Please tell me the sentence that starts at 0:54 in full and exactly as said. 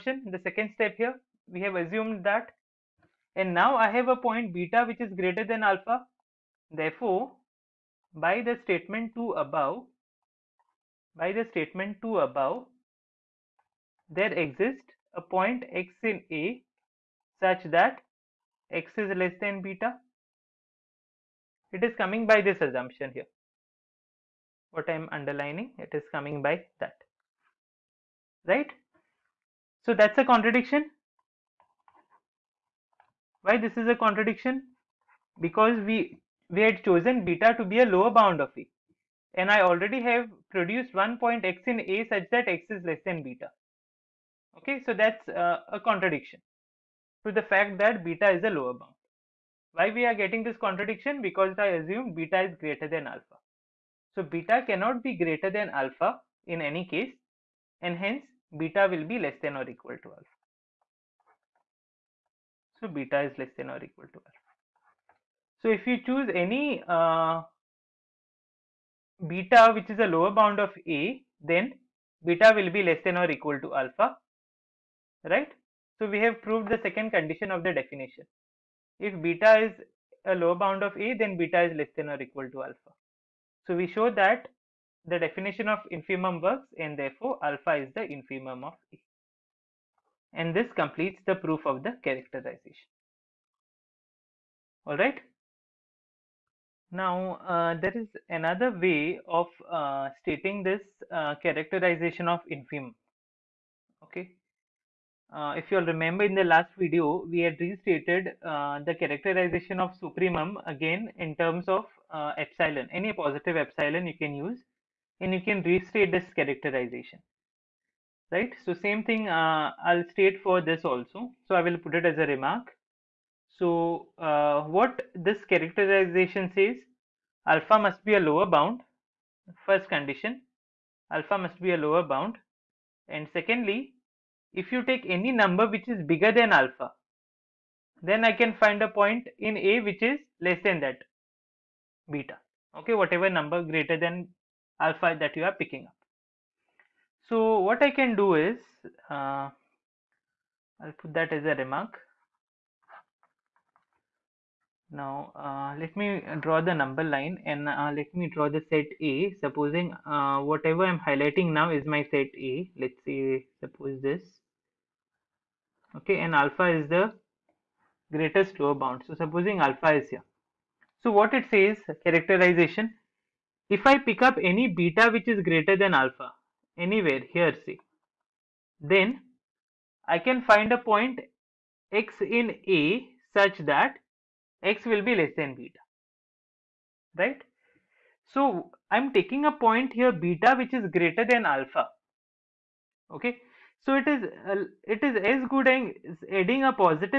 So beta cannot be greater than alpha in any case and hence beta will be less than or equal to alpha.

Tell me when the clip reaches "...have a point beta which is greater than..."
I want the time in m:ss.
0:03.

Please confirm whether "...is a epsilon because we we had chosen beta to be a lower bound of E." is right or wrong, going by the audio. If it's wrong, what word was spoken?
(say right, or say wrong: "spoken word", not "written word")
wrong: "contradiction", not "epsilon".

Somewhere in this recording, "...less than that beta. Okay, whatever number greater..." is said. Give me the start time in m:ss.
2:20.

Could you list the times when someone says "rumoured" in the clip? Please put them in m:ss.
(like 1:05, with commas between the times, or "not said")
not said.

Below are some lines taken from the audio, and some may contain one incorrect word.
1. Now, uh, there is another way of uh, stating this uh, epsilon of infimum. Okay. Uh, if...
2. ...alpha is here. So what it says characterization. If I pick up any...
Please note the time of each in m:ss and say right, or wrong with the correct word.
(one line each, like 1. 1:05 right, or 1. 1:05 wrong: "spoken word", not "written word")
1. 1:36 wrong: "characterization", not "epsilon"
2. 2:49 right.